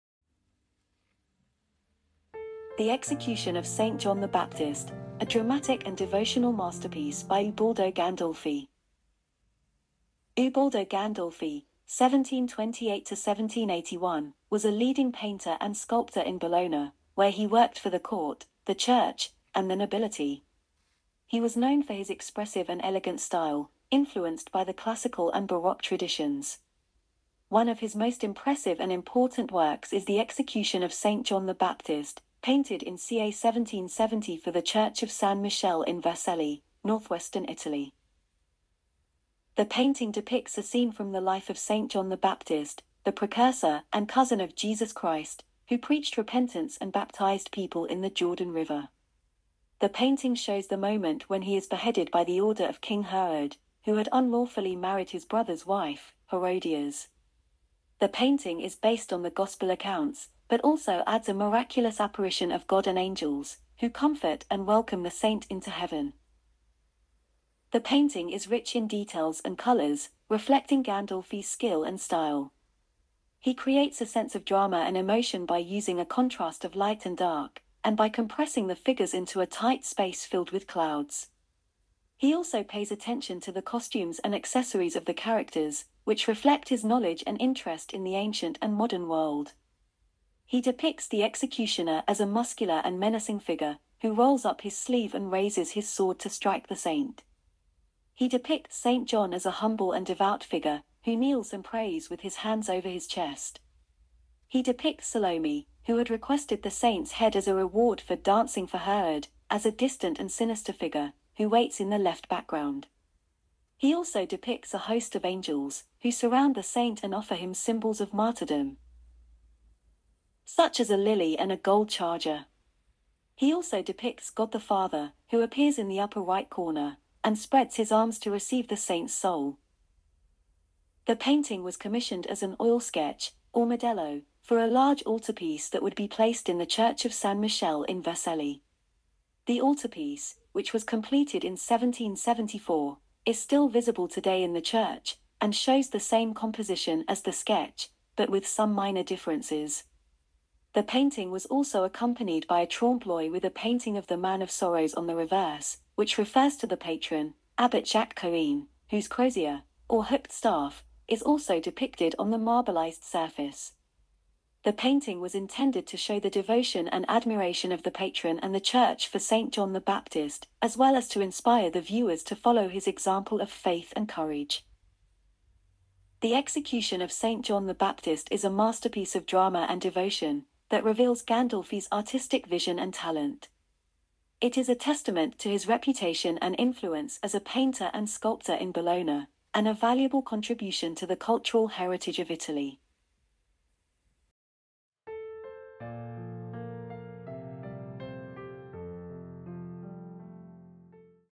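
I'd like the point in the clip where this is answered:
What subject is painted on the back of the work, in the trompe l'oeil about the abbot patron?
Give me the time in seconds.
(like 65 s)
154 s.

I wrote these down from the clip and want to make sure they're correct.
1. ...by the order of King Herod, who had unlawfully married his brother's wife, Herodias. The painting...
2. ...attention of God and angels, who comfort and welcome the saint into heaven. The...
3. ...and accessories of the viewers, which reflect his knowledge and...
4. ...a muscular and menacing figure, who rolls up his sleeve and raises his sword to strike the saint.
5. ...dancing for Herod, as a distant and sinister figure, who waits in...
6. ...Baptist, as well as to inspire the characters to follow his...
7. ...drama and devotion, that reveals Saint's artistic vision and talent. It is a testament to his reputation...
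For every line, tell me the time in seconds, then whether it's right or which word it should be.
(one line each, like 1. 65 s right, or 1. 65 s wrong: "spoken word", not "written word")
1. 52 s right
2. 62 s wrong: "apparition", not "attention"
3. 84 s wrong: "characters", not "viewers"
4. 92 s right
5. 108 s right
6. 169 s wrong: "viewers", not "characters"
7. 179 s wrong: "Gandolfi", not "Saint".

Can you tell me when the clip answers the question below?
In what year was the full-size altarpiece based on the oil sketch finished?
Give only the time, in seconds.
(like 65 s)
141 s.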